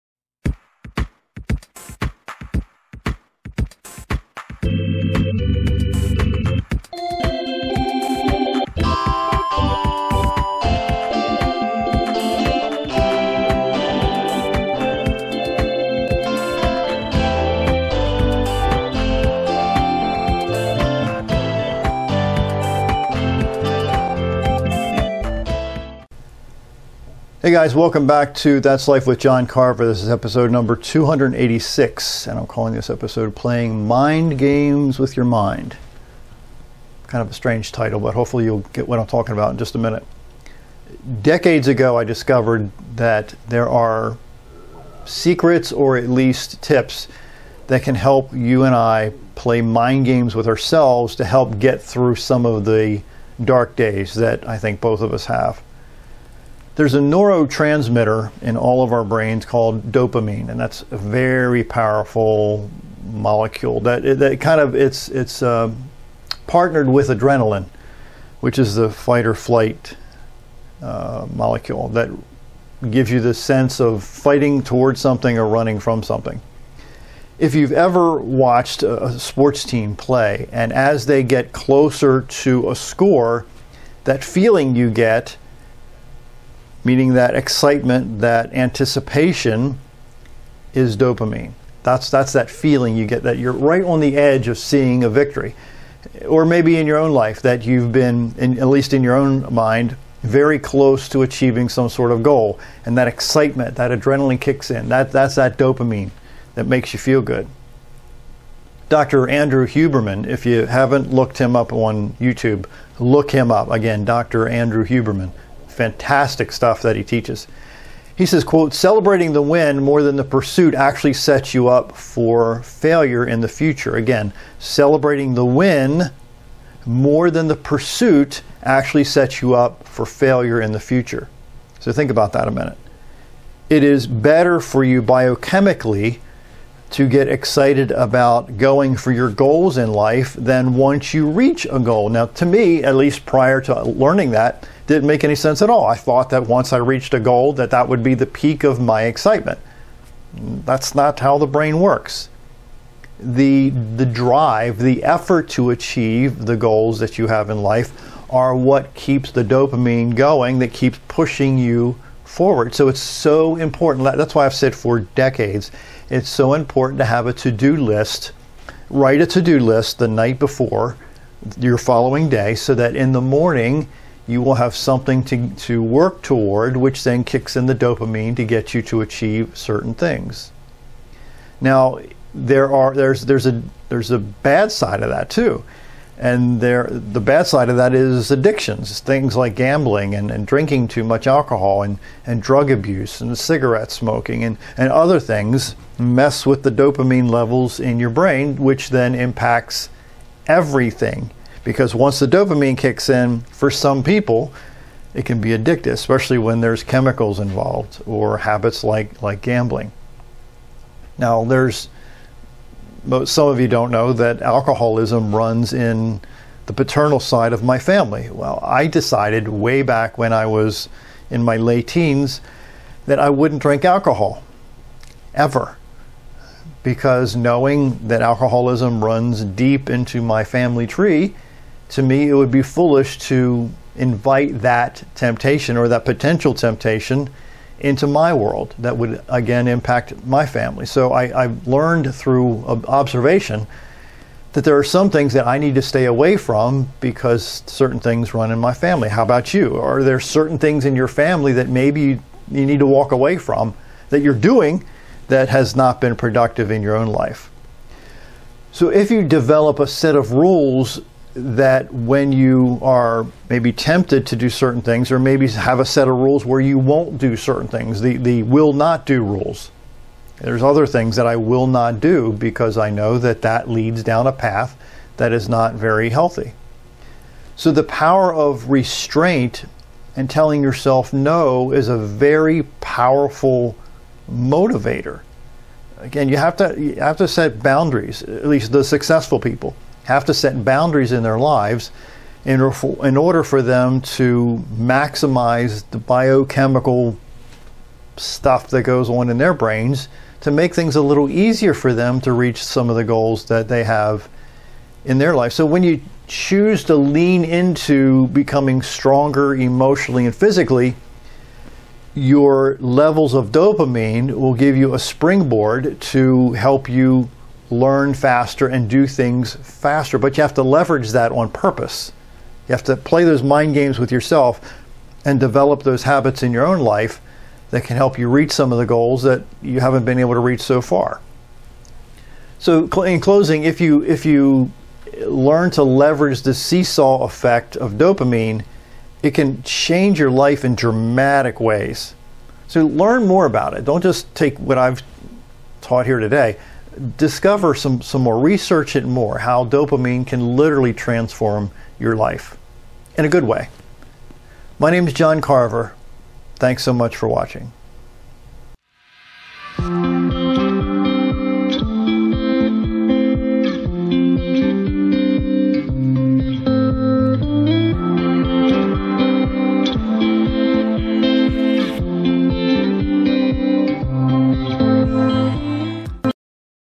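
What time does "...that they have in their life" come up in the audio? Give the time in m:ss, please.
5:03.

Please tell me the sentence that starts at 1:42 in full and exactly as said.
And that excitement, that adrenaline kicks in.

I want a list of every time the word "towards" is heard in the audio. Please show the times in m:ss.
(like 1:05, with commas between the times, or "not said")
1:14, 2:56.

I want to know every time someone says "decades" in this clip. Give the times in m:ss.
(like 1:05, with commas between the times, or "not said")
0:41, 2:45.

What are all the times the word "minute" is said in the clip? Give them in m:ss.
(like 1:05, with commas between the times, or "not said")
0:39, 2:12.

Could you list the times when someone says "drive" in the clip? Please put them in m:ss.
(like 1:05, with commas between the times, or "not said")
2:34.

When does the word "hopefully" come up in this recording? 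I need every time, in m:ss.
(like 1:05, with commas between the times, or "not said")
0:38.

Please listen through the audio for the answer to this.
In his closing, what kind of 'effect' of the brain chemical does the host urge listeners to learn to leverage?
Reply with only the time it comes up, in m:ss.
5:36.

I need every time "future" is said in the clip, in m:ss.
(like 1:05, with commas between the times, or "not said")
2:03, 2:10.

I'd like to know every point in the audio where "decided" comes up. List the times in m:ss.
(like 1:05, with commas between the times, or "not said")
3:38.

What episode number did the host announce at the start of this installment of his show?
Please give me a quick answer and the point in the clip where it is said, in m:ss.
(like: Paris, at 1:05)
286, at 0:30.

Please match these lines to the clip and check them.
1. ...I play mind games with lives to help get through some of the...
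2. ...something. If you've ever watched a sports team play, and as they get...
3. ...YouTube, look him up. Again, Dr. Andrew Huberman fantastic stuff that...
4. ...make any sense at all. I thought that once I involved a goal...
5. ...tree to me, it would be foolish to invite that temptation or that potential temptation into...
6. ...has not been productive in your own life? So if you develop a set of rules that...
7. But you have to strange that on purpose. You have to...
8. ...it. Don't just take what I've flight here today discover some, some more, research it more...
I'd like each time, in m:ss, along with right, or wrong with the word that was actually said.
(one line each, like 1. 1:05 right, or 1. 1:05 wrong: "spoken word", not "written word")
1. 0:48 wrong: "ourselves", not "lives"
2. 1:16 right
3. 1:52 right
4. 2:25 wrong: "reached", not "involved"
5. 3:50 right
6. 4:15 right
7. 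5:20 wrong: "leverage", not "strange"
8. 5:43 wrong: "taught", not "flight".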